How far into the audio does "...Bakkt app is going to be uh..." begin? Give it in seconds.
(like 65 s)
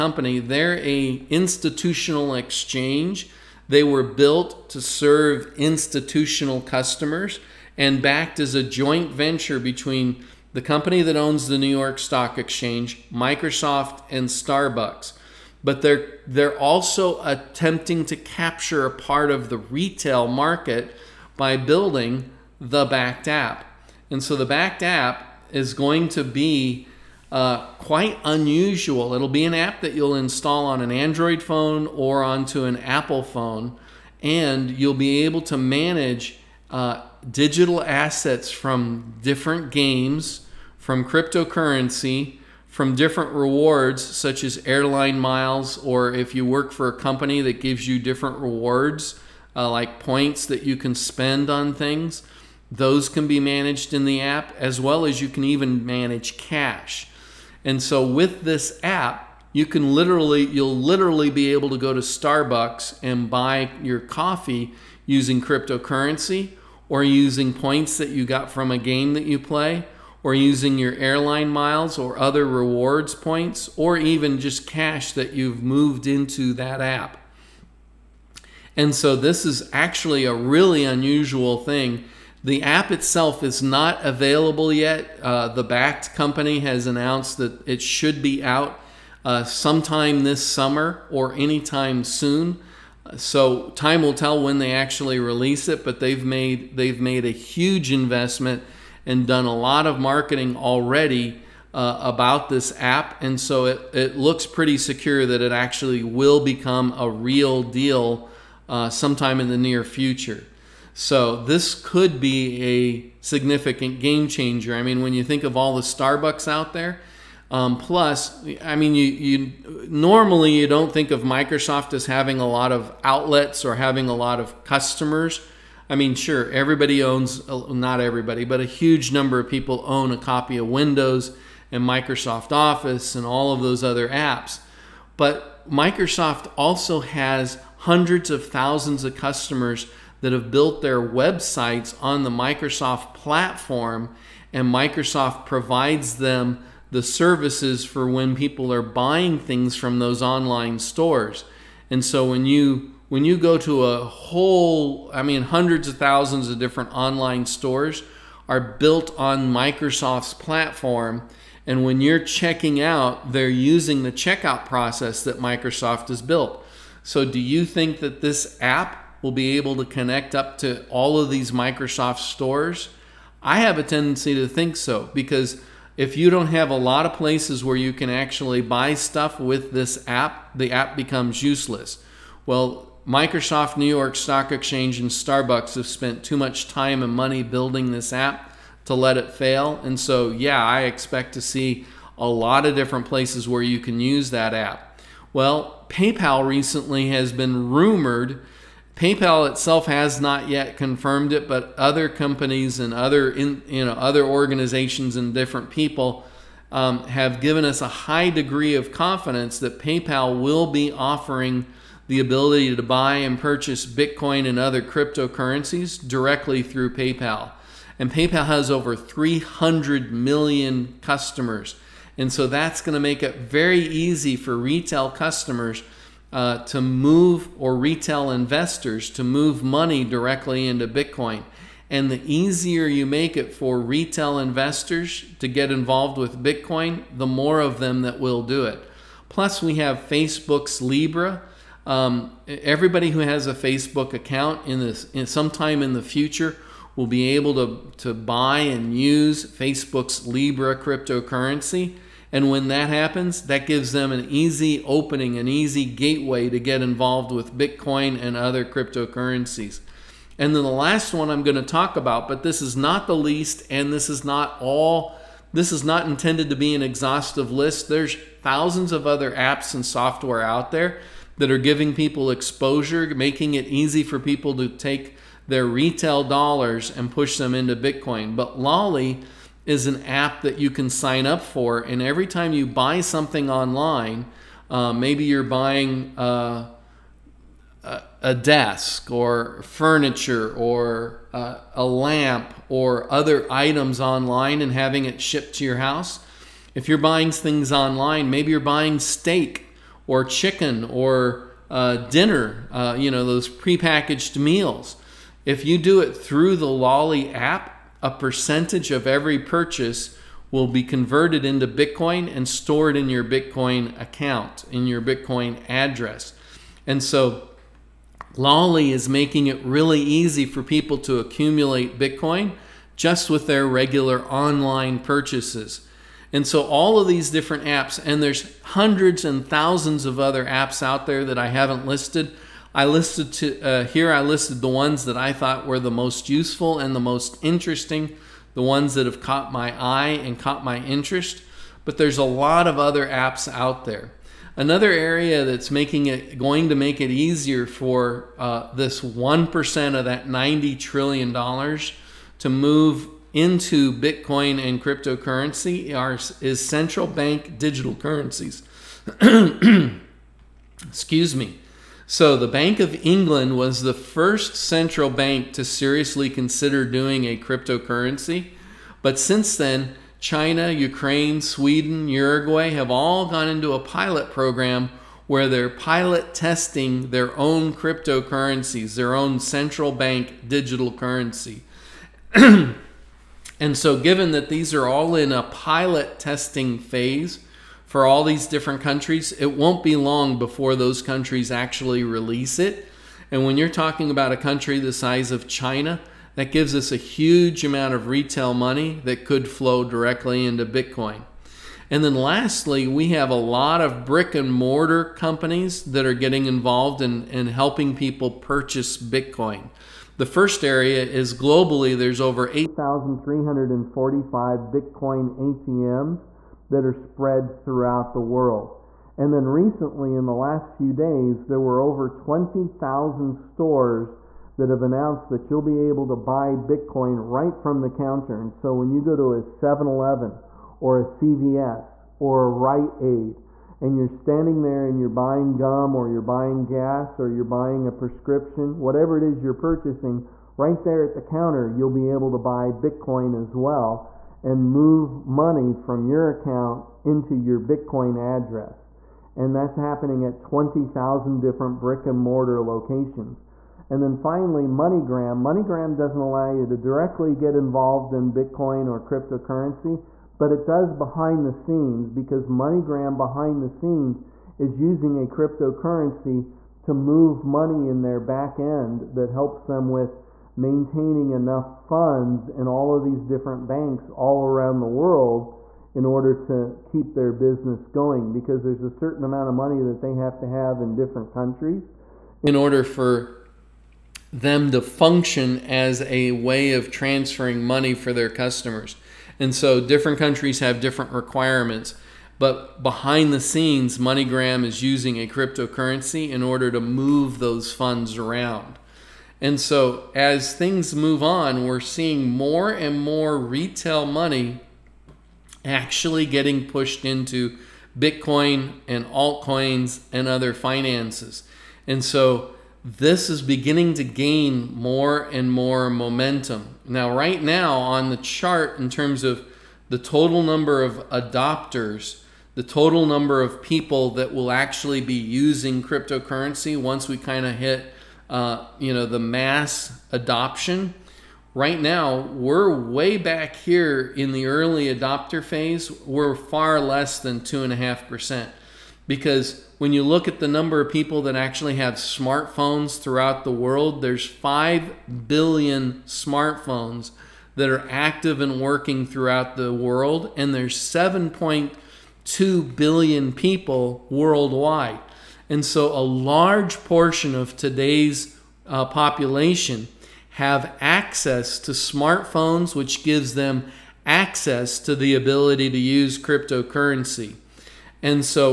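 24 s.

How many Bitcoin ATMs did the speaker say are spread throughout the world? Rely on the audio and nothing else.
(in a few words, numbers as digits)
8,345.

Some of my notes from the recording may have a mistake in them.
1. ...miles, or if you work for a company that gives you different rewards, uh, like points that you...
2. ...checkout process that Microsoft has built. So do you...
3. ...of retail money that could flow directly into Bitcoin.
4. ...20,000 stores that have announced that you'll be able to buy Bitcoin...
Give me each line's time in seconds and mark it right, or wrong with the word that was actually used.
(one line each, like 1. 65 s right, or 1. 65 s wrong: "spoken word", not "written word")
1. 45 s right
2. 164 s right
3. 397 s right
4. 422 s right.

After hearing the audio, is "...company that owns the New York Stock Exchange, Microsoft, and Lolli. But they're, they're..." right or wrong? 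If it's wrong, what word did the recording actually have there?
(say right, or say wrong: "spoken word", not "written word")
wrong: "Starbucks", not "Lolli".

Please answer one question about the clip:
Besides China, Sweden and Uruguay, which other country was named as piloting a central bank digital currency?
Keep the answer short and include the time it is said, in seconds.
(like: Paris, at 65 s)
Ukraine, at 370 s.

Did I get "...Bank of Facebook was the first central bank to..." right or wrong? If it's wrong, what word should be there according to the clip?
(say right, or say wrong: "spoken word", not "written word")
wrong: "England", not "Facebook".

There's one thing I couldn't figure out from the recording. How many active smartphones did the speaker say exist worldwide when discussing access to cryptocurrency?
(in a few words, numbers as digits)
5 billion.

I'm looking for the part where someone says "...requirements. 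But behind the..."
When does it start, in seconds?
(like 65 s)
491 s.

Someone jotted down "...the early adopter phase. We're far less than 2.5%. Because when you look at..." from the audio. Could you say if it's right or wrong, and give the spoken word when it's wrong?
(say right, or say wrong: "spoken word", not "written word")
right.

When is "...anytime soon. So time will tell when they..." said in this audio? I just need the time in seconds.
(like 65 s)
91 s.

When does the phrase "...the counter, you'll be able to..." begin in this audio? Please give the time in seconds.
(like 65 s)
441 s.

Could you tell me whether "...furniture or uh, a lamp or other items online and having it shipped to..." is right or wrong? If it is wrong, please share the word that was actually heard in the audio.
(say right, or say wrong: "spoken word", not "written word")
right.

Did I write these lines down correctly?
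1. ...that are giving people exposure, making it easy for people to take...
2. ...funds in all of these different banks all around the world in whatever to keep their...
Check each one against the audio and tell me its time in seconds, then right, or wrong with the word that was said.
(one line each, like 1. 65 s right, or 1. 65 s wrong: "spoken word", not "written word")
1. 271 s right
2. 471 s wrong: "order", not "whatever".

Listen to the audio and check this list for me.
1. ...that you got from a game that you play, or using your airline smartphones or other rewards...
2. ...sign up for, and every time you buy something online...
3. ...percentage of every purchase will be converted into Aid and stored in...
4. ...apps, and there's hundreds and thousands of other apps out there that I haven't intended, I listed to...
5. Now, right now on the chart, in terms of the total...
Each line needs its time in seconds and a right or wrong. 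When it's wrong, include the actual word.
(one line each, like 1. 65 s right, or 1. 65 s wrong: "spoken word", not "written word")
1. 67 s wrong: "miles", not "smartphones"
2. 280 s right
3. 308 s wrong: "Bitcoin", not "Aid"
4. 327 s wrong: "listed", not "intended"
5. 516 s right.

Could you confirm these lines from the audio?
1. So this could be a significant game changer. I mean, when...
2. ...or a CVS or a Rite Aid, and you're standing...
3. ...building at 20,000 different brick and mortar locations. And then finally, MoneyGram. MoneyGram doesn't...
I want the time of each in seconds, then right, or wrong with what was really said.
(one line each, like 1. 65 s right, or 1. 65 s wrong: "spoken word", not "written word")
1. 110 s right
2. 430 s right
3. 449 s wrong: "happening", not "building".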